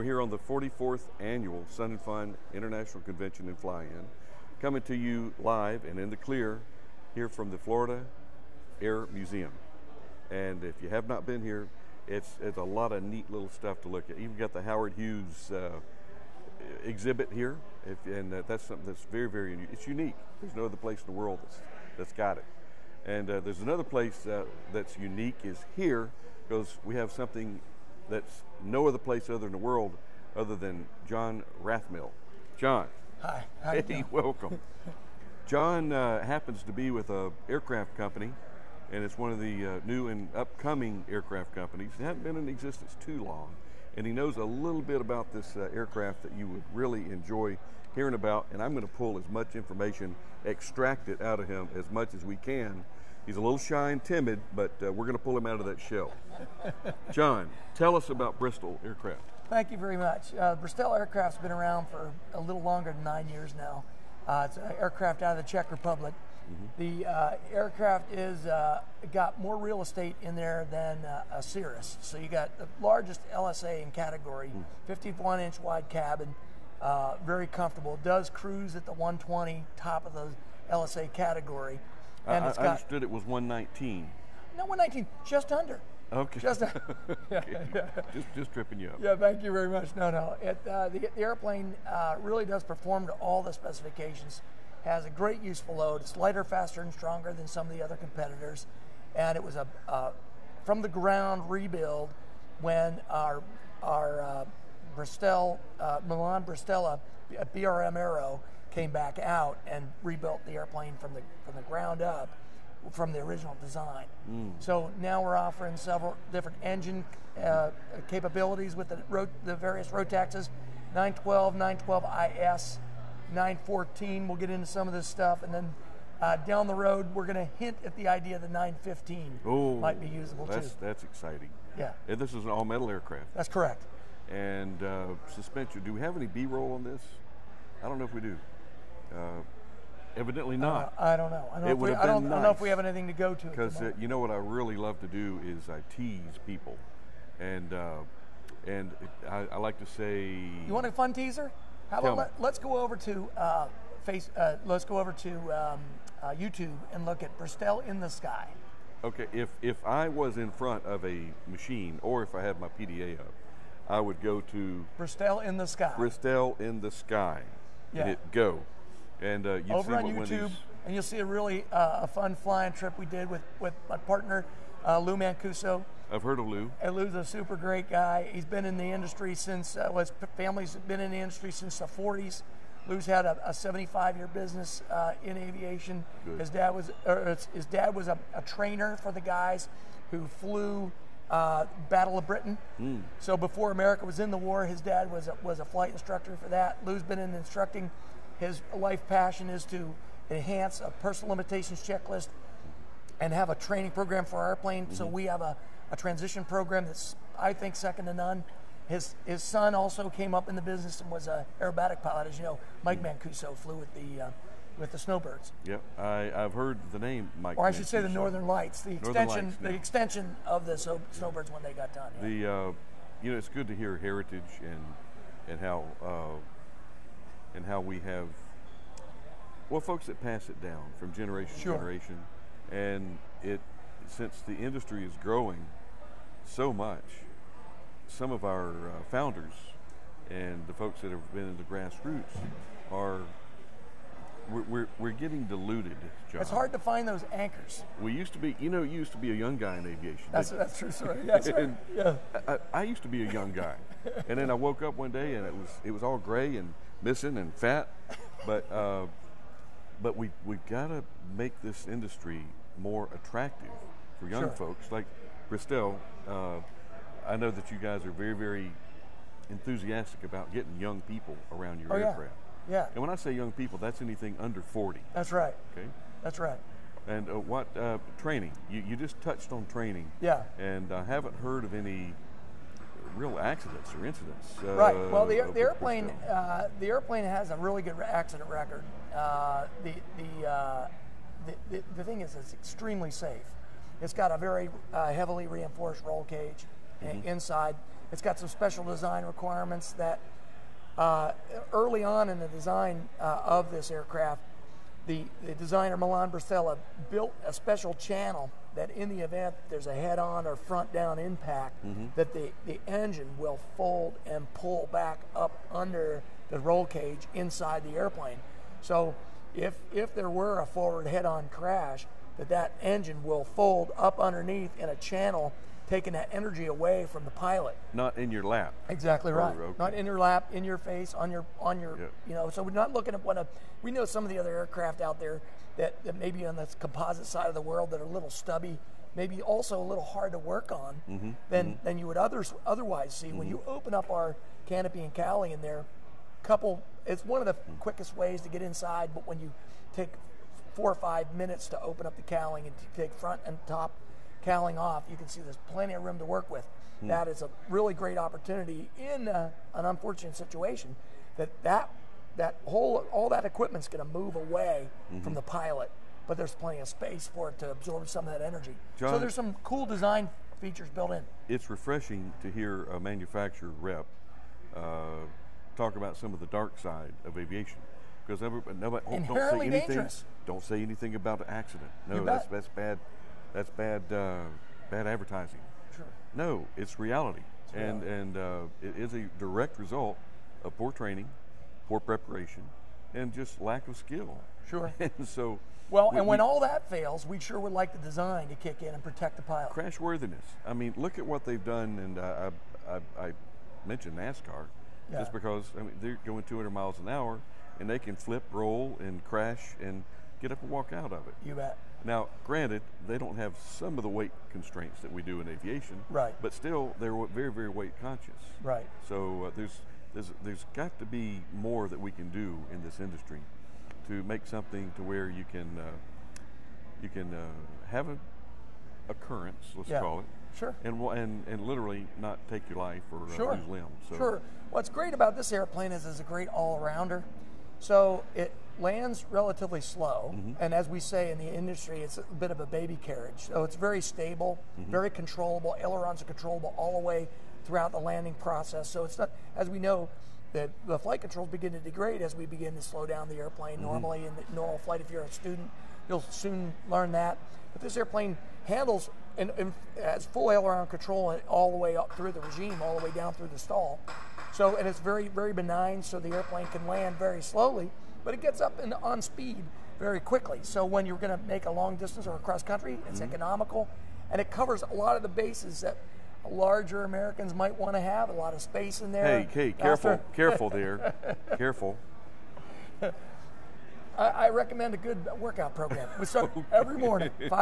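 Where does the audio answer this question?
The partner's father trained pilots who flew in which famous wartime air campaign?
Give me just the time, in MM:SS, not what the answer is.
03:11.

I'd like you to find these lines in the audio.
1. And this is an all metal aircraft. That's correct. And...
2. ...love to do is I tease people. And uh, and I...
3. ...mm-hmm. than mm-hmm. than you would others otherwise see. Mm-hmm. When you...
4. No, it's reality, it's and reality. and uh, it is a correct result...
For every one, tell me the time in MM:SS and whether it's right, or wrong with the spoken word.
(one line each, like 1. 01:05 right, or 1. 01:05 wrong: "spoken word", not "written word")
1. 02:12 right
2. 02:24 right
3. 05:41 right
4. 06:26 wrong: "direct", not "correct".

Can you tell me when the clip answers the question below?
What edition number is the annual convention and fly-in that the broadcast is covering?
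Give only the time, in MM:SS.
00:00.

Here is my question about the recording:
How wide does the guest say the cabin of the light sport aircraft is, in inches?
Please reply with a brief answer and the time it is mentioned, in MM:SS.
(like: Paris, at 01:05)
51, at 01:14.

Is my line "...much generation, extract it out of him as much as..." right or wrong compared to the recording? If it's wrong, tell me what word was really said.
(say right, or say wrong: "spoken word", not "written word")
wrong: "information", not "generation".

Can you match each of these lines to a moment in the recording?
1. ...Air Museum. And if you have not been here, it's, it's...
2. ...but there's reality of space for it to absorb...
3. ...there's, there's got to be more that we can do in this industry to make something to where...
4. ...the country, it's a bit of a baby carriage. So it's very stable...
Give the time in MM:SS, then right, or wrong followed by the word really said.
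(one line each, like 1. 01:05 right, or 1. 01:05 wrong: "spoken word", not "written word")
1. 00:08 right
2. 06:06 wrong: "plenty", not "reality"
3. 07:00 right
4. 07:21 wrong: "industry", not "country".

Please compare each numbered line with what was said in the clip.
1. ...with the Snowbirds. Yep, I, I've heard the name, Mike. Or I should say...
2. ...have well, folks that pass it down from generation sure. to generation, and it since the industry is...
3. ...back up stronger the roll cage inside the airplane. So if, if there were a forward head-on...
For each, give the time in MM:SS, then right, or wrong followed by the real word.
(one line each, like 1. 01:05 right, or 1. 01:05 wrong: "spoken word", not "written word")
1. 03:34 right
2. 03:47 right
3. 05:14 wrong: "under", not "stronger".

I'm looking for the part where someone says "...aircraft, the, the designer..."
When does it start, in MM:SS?
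05:03.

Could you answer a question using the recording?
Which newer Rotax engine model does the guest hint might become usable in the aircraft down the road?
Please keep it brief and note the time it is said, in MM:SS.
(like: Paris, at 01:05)
915, at 02:08.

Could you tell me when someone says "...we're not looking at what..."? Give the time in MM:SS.
05:32.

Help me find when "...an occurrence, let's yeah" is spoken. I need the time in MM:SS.
07:08.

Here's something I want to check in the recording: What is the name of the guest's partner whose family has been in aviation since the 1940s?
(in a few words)
Lou Mancuso.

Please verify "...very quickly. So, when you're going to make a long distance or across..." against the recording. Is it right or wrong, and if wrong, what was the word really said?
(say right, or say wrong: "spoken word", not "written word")
right.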